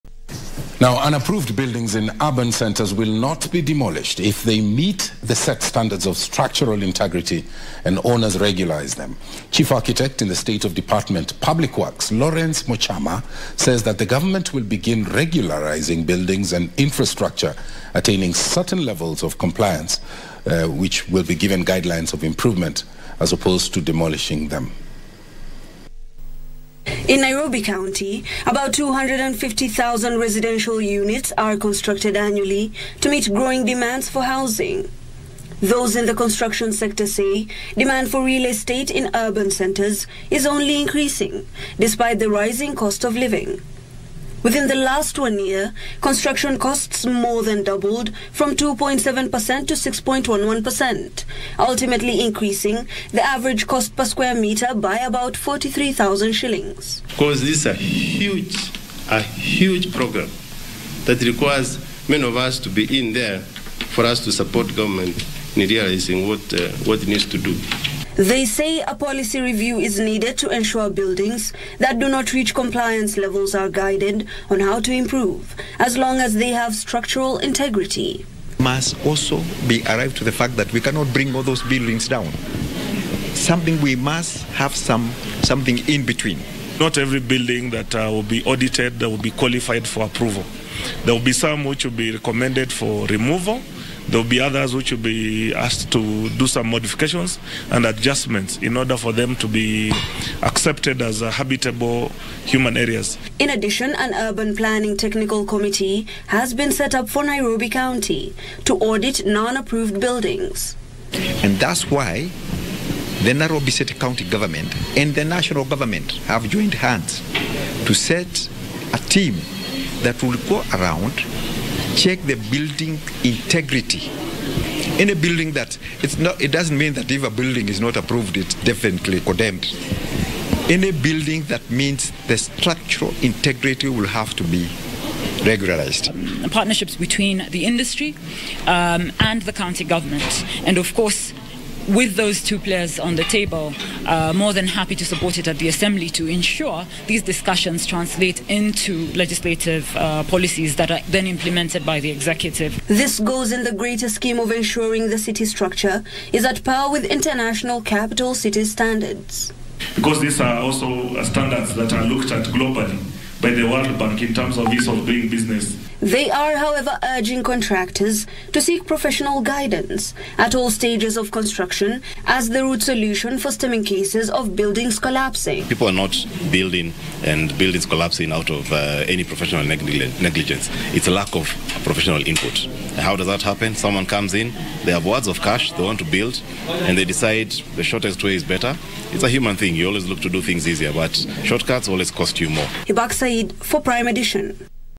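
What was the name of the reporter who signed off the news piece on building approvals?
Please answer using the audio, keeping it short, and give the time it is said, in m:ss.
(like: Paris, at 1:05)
Ibak Said, at 3:12.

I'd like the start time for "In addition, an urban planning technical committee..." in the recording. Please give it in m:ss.
1:43.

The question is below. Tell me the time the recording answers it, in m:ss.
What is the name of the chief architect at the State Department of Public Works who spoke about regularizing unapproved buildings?
0:12.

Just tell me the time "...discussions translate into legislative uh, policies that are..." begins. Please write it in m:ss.
2:27.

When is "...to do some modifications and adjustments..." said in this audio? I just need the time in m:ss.
1:35.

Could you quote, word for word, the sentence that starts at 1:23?
Something we must have some something in between.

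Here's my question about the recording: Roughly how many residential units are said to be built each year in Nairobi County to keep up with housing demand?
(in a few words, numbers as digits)
250,000.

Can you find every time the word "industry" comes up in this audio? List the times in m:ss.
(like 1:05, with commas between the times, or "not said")
2:17.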